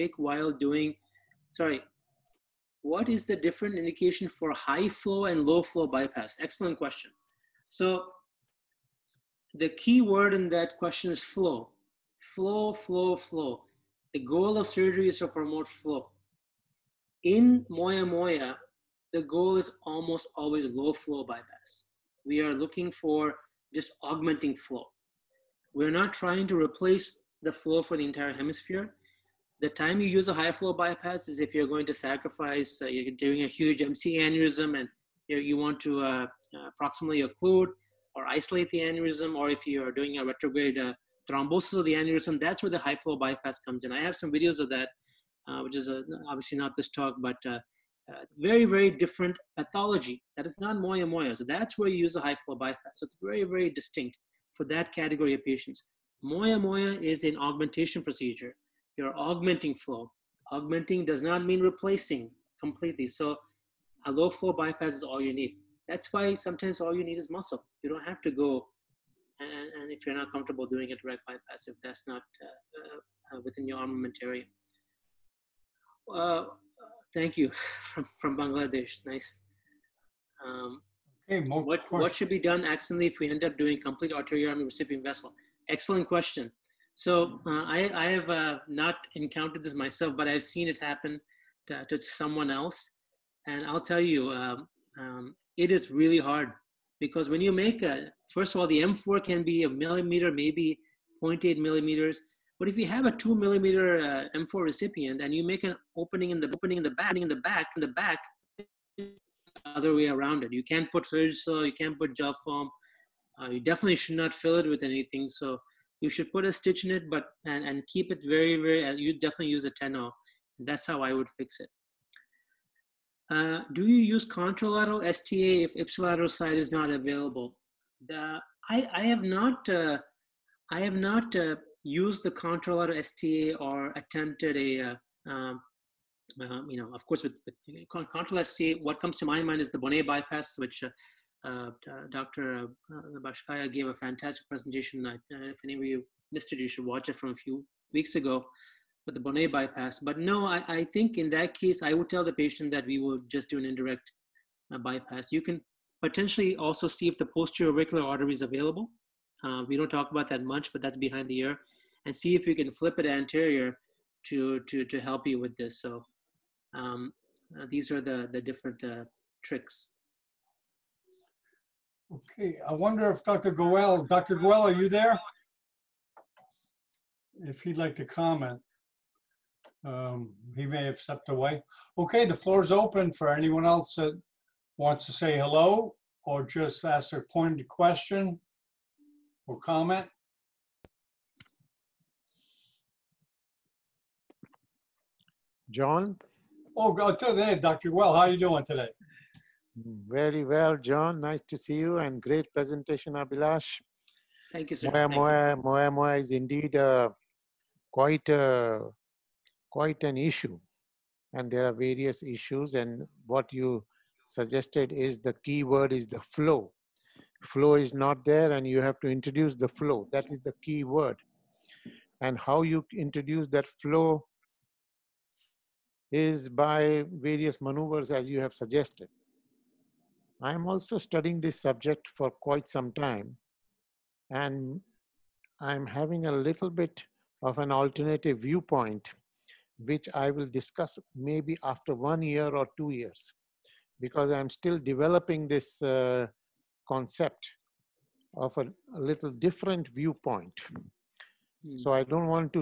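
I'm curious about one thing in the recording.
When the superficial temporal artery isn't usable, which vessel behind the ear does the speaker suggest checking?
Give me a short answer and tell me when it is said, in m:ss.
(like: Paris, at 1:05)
Posterior auricular artery, at 2:37.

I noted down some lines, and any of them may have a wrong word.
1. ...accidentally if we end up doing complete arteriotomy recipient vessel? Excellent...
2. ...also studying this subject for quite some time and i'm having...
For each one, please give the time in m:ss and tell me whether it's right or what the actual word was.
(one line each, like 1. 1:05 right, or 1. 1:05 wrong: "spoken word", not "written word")
1. 1:22 right
2. 3:50 right.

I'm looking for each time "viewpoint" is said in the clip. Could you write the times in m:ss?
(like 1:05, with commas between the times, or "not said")
3:58, 4:09.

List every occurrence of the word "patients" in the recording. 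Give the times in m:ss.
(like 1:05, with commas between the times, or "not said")
0:55, 2:32.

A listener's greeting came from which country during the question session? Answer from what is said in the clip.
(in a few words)
Bangladesh.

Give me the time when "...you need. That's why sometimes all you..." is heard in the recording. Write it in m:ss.
1:05.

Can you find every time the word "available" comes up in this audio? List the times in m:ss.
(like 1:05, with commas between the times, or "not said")
2:06, 2:38.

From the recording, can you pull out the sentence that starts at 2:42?
And see if you can flip it anterior to, to, to help you with this.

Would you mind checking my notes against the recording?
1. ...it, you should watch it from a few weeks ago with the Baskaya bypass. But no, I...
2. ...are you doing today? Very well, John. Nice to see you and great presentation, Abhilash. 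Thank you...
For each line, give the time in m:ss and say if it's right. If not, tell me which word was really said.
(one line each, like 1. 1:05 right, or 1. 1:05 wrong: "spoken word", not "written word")
1. 2:26 wrong: "Bonnet", not "Baskaya"
2. 3:18 right.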